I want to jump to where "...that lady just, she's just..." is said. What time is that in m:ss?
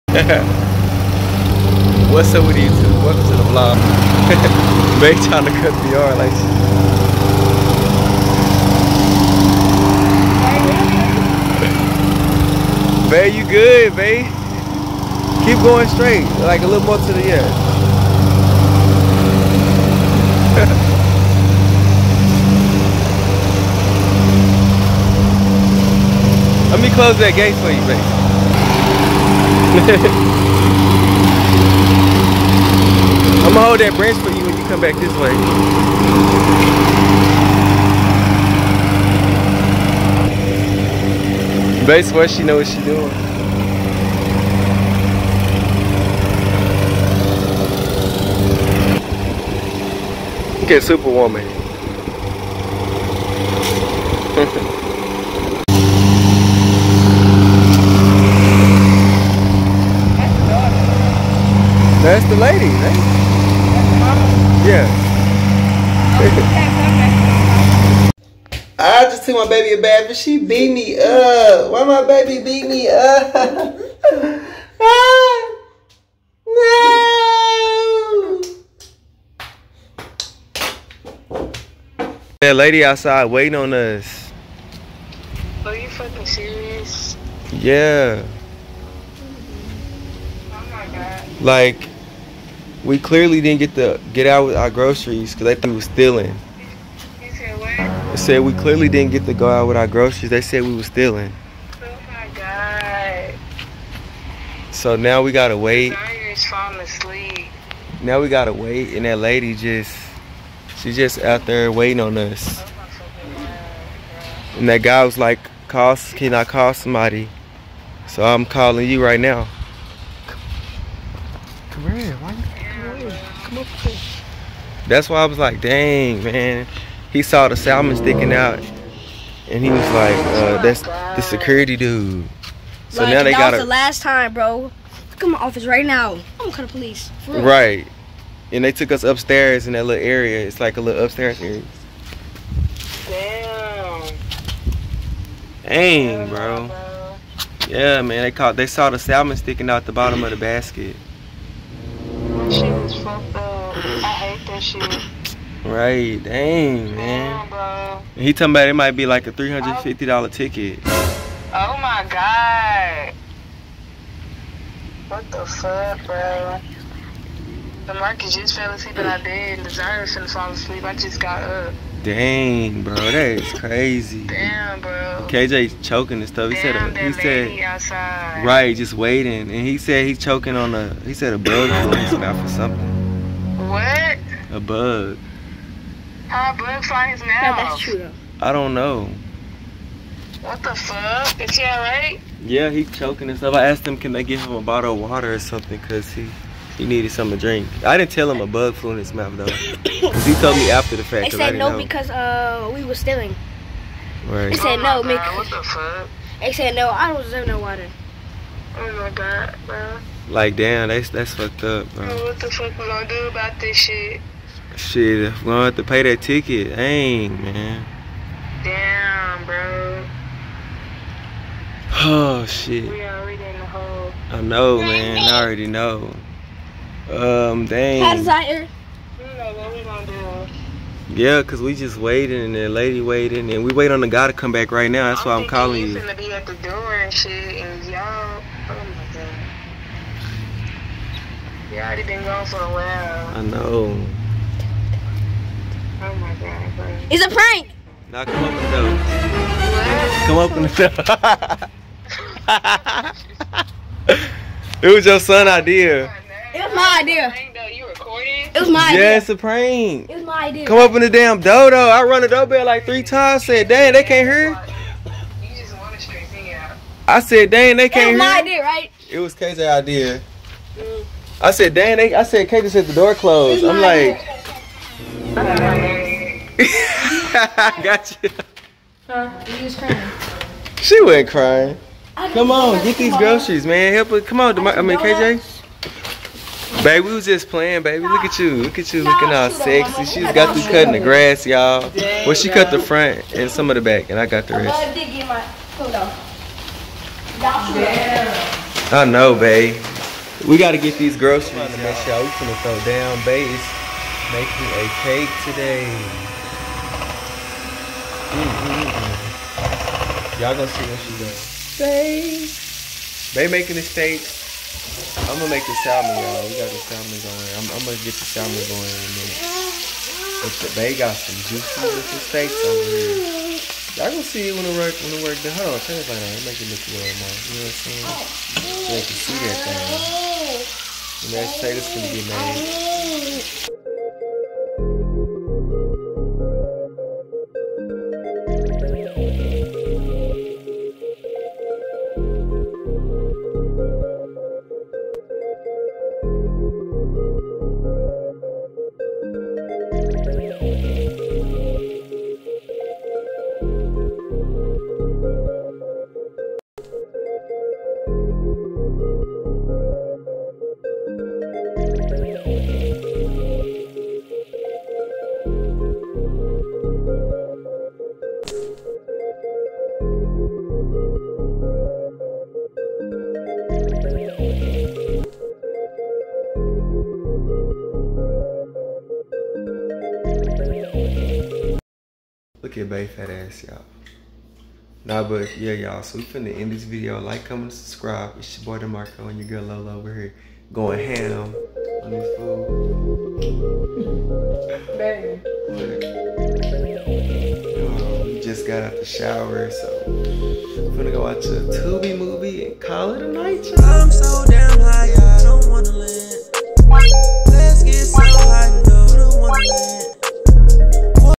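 1:49.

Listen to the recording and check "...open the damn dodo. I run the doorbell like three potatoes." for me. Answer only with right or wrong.
wrong.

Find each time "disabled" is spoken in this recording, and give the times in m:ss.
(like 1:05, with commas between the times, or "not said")
not said.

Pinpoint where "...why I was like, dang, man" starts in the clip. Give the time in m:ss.
2:05.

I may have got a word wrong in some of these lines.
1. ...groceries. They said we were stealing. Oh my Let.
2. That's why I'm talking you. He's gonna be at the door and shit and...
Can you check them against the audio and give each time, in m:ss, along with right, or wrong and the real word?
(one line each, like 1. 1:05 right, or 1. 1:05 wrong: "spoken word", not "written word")
1. 1:39 wrong: "God", not "Let"
2. 3:55 wrong: "calling", not "talking".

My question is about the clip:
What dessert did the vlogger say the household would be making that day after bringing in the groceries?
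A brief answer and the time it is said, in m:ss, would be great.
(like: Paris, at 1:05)
a cake, at 5:04.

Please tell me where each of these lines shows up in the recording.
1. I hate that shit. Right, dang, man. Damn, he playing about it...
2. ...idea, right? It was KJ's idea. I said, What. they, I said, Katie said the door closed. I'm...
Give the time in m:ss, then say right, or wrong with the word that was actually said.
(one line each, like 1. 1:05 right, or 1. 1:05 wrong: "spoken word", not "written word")
1. 2:34 wrong: "talking", not "playing"
2. 4:28 wrong: "Dan", not "What".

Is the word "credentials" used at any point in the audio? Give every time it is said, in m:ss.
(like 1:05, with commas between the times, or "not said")
not said.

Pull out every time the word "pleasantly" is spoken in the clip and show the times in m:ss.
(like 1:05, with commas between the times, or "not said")
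not said.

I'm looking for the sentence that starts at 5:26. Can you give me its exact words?
Make it look a little more.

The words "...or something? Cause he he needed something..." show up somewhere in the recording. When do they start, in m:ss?
3:15.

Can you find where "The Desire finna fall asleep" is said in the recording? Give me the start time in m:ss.
2:49.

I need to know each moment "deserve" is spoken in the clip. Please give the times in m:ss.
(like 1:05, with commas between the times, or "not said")
3:27.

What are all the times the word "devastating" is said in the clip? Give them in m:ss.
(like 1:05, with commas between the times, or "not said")
not said.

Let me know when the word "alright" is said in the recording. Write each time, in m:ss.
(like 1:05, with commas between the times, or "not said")
3:11.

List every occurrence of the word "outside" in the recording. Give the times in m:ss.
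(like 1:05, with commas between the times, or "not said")
1:22, 2:57.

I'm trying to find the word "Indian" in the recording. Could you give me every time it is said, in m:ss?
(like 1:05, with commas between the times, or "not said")
not said.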